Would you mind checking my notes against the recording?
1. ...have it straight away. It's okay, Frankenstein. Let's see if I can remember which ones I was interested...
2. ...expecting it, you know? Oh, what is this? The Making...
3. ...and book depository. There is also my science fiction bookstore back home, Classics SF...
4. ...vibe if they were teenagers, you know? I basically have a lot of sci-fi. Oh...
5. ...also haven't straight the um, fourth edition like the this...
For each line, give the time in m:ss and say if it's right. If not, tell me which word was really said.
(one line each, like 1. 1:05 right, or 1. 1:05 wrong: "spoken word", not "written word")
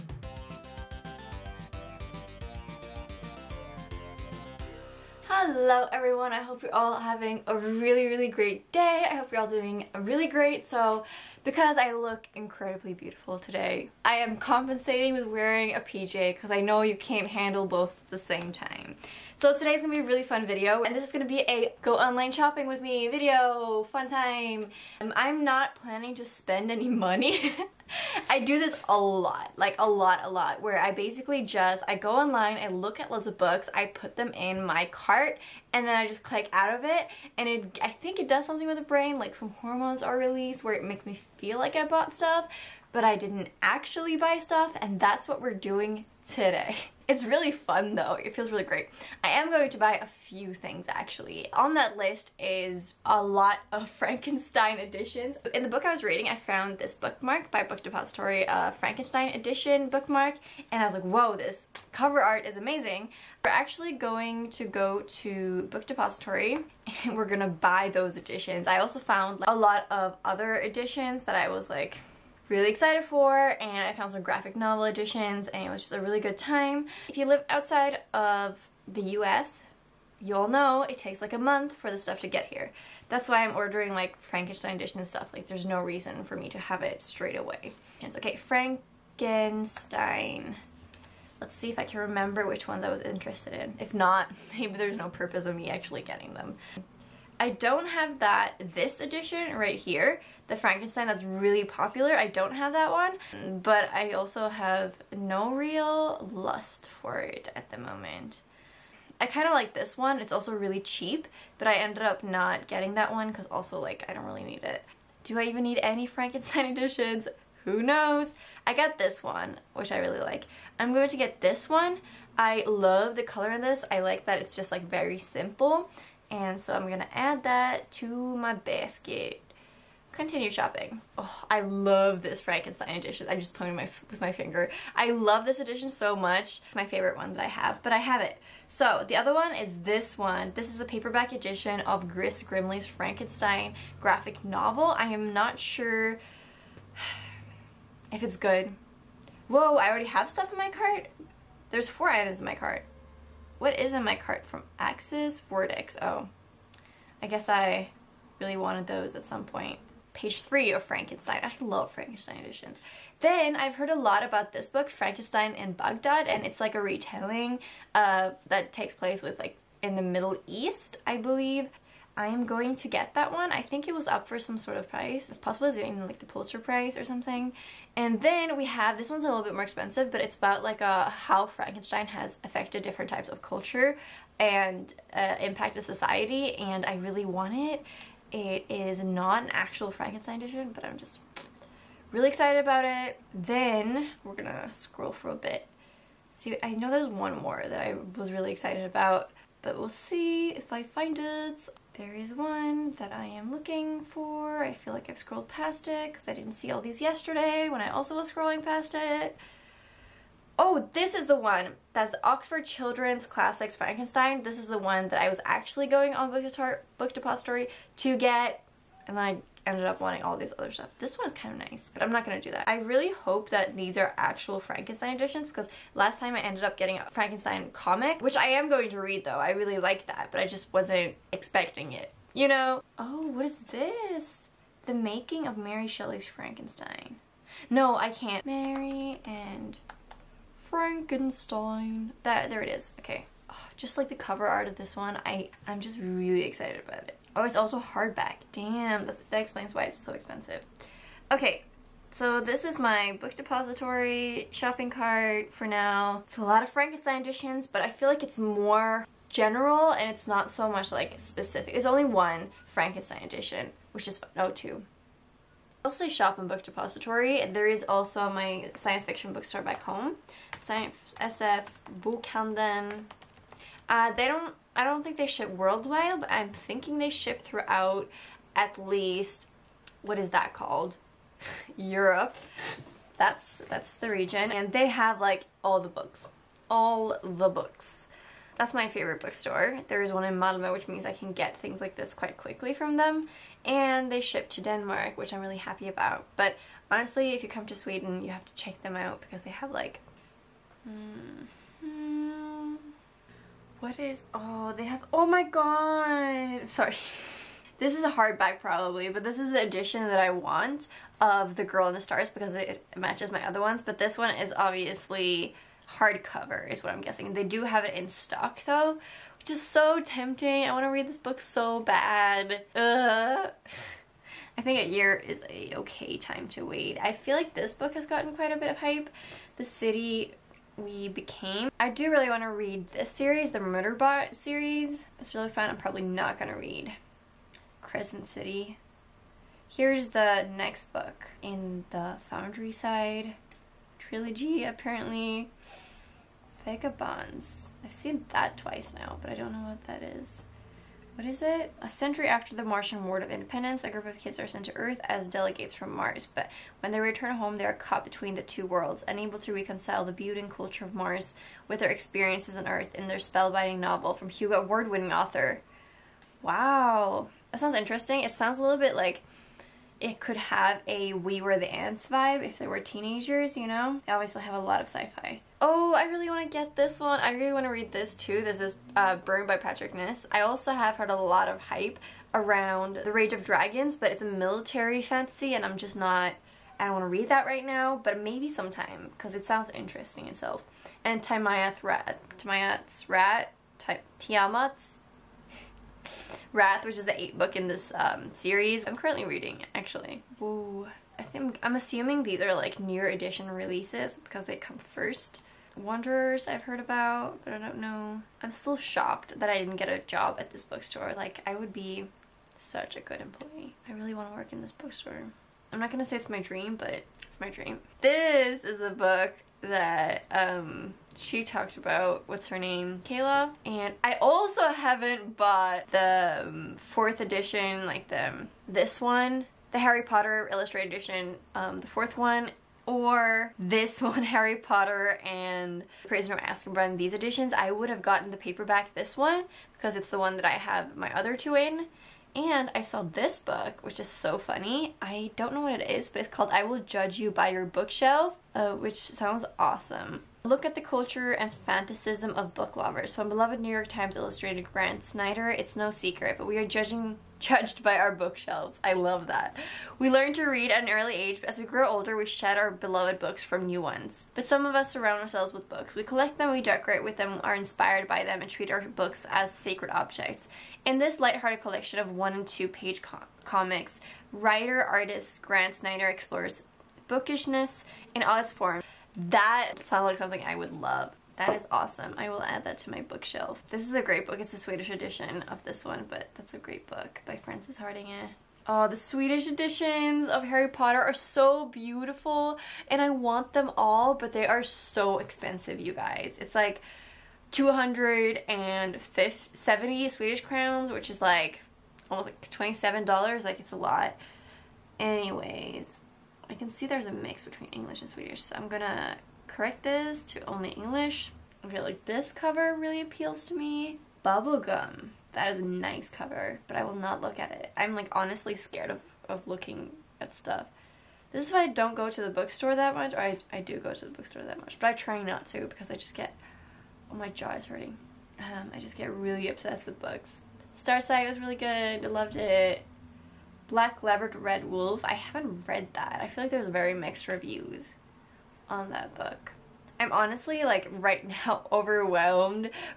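1. 1:26 right
2. 3:51 right
3. 4:26 wrong: "Science", not "Classics"
4. 6:12 wrong: "obviously", not "basically"
5. 7:04 wrong: "bought", not "straight".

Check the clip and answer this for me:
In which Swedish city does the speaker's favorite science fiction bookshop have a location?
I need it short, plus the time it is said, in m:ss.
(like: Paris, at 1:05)
Malmö, at 4:50.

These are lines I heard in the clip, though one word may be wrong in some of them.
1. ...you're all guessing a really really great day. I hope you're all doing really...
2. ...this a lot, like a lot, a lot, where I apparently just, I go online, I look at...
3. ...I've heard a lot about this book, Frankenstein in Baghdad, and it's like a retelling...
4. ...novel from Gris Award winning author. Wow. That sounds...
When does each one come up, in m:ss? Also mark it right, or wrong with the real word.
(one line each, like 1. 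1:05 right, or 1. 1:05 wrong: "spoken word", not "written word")
1. 0:06 wrong: "having", not "guessing"
2. 0:28 wrong: "basically", not "apparently"
3. 2:43 right
4. 6:03 wrong: "Hugo", not "Gris".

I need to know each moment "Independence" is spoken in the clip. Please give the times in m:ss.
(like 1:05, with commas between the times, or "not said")
5:53.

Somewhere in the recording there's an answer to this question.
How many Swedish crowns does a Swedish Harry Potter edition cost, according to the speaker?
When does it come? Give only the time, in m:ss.
8:17.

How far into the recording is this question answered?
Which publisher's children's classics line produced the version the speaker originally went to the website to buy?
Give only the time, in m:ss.
3:32.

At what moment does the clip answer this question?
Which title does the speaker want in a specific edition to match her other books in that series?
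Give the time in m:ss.
5:11.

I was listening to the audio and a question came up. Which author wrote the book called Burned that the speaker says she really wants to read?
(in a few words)
Patrick Ness.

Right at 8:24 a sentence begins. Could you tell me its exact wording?
Anyways, I can see there's a mix between English and Swedish, so I'm gonna correct this to only English.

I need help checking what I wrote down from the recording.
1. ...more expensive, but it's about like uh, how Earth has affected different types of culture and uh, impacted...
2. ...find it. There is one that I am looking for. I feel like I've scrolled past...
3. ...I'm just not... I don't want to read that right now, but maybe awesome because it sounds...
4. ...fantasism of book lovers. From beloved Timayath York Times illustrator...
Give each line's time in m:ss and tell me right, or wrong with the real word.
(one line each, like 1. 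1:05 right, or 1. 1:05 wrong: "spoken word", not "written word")
1. 2:59 wrong: "Frankenstein", not "Earth"
2. 3:20 right
3. 6:25 wrong: "sometime", not "awesome"
4. 7:31 wrong: "New", not "Timayath".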